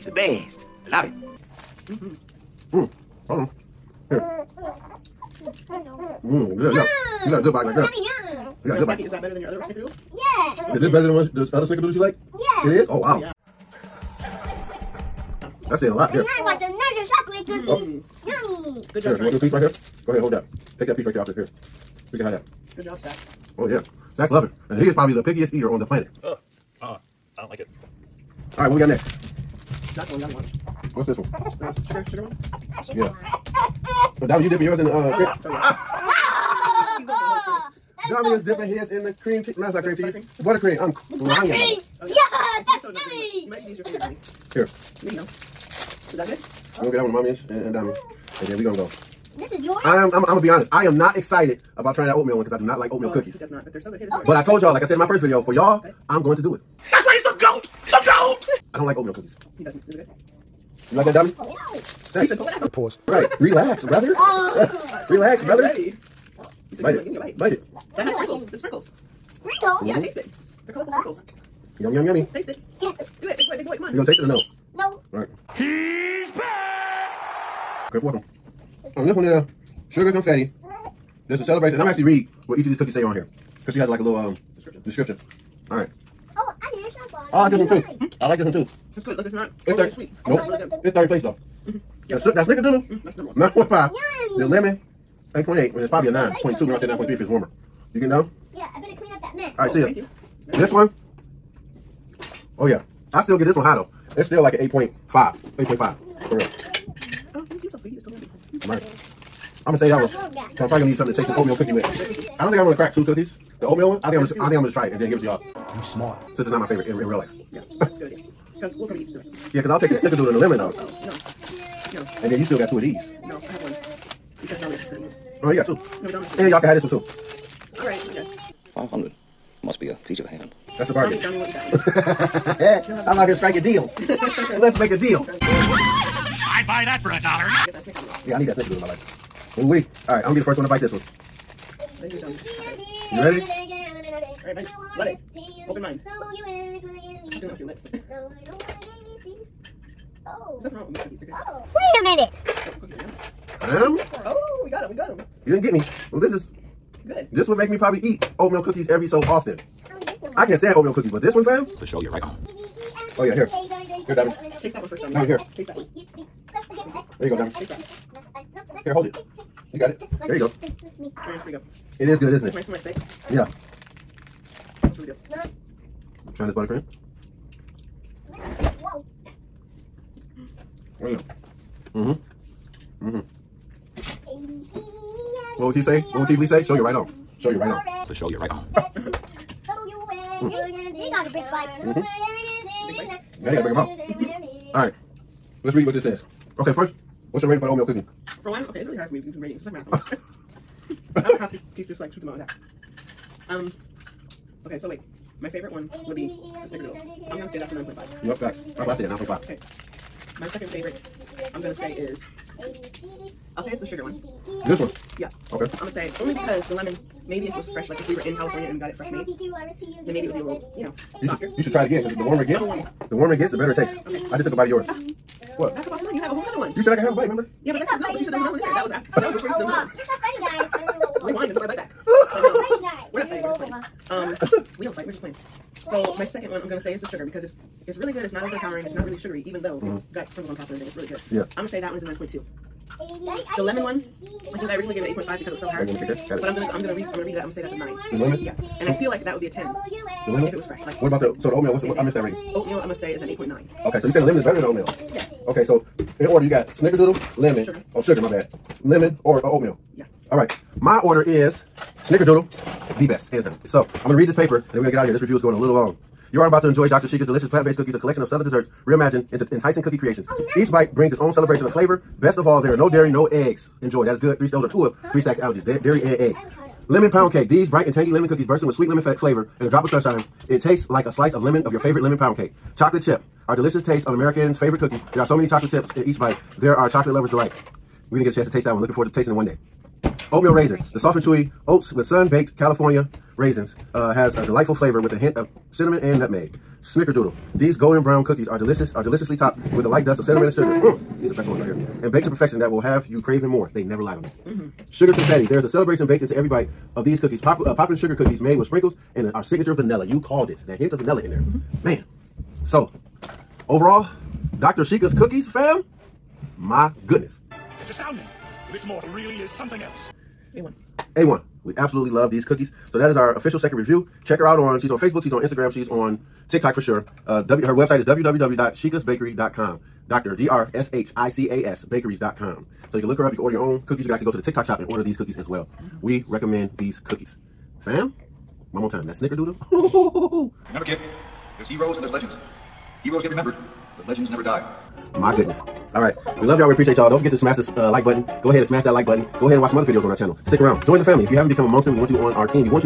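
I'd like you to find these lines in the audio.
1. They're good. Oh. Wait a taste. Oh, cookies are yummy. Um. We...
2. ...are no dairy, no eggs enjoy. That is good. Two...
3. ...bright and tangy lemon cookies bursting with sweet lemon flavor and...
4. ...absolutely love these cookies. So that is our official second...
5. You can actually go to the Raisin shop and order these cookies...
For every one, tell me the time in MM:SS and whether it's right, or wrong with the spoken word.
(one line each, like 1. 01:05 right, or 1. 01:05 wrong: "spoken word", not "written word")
1. 02:31 wrong: "minute", not "taste"
2. 04:32 wrong: "Three", not "Two"
3. 04:37 right
4. 05:21 right
5. 05:34 wrong: "TikTok", not "Raisin".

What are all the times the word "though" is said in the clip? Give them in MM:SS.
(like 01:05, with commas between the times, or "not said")
01:31, 01:43, 02:00, 03:59.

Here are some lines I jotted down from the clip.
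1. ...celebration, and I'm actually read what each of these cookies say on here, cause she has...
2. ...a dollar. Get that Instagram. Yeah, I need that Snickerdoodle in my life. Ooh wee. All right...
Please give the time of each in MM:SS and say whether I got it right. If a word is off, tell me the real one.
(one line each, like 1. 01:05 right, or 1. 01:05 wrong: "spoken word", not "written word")
1. 01:21 right
2. 02:17 wrong: "Snickerdoodle", not "Instagram".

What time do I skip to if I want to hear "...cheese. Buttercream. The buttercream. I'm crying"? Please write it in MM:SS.
00:39.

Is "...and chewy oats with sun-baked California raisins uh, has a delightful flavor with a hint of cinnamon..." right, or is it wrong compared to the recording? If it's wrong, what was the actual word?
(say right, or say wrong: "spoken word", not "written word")
right.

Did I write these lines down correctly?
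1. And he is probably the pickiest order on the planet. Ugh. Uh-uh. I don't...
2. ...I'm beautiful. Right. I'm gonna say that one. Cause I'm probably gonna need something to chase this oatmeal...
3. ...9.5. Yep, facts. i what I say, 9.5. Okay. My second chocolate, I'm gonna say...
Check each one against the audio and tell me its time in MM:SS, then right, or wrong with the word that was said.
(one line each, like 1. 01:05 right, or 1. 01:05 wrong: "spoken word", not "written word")
1. 00:24 wrong: "eater", not "order"
2. 01:48 right
3. 03:27 wrong: "favorite", not "chocolate".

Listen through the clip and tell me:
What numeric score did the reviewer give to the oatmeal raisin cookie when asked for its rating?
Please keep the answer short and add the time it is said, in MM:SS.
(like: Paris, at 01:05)
8.9, at 04:13.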